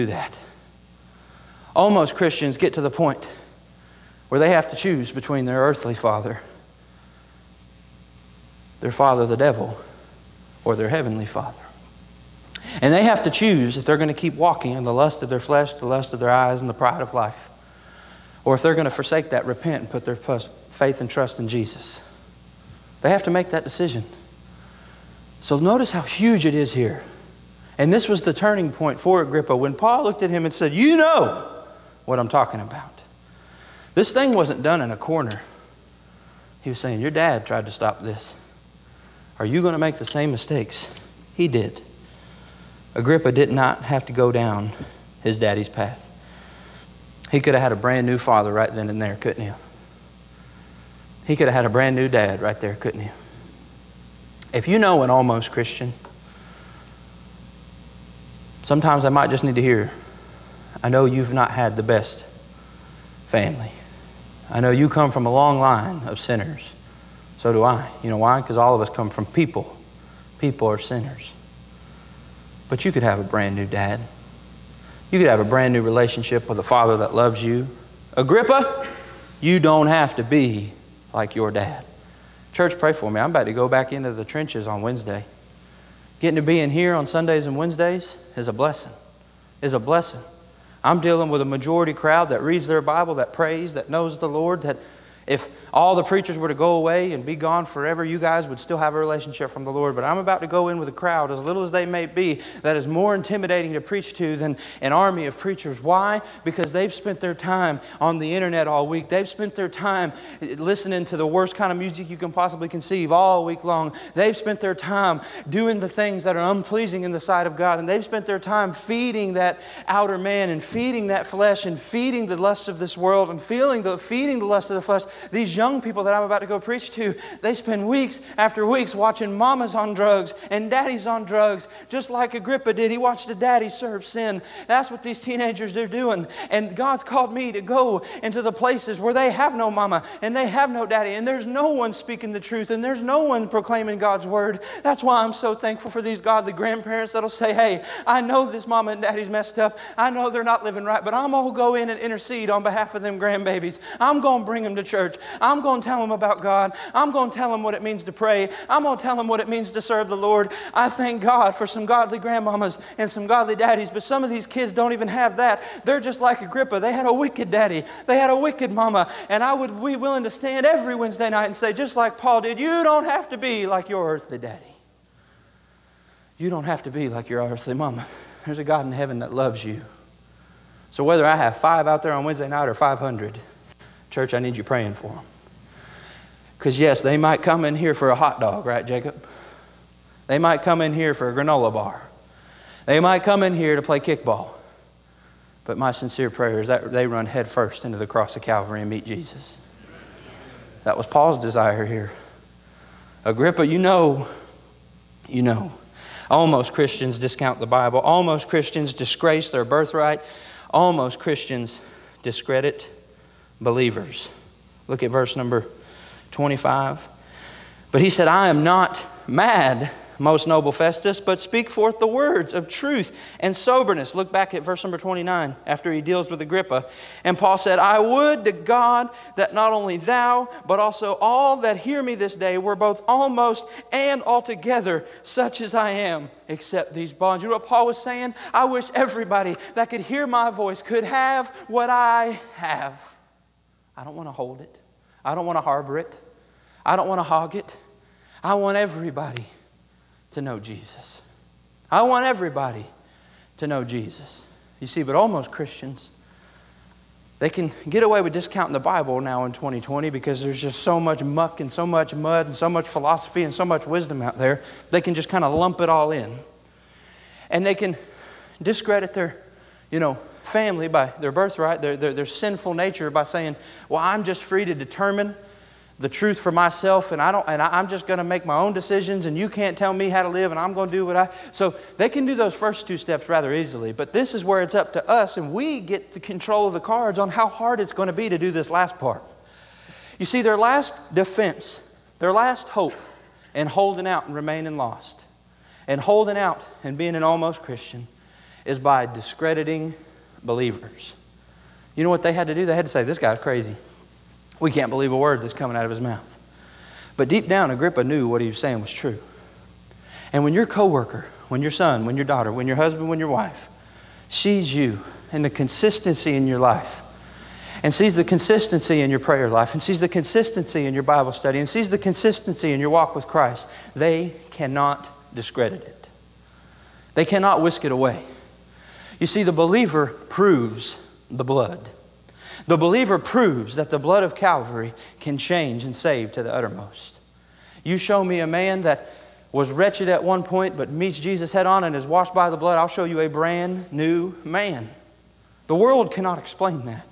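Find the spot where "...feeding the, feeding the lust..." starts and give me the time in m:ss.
2:03.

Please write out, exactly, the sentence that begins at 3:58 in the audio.
I wish everybody that could hear my voice could have what I have.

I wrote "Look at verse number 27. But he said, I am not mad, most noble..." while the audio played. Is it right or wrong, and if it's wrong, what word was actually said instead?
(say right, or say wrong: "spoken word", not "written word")
wrong: "25", not "27".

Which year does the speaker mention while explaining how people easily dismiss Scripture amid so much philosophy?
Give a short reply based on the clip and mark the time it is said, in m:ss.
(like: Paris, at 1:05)
2020, at 4:19.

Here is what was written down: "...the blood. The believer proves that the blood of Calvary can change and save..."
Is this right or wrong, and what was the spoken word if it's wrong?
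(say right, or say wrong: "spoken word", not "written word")
right.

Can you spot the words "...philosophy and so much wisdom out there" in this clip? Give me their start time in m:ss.
4:22.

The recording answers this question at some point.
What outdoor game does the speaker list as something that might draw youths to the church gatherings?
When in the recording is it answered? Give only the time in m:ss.
3:13.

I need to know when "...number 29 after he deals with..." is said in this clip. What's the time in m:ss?
3:44.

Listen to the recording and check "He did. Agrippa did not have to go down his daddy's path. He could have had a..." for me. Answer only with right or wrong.
right.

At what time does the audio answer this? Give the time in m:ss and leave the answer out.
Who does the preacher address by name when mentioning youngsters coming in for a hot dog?
3:08.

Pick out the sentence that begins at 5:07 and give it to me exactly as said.
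But deep down, Agrippa knew what he was saying was true.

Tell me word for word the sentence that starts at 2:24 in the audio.
That's why I'm so thankful for these godly grandparents that'll say, Hey, I know this mama and daddy's messed up.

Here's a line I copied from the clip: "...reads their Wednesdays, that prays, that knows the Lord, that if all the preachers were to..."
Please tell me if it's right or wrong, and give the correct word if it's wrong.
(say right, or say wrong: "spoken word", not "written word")
wrong: "Bible", not "Wednesdays".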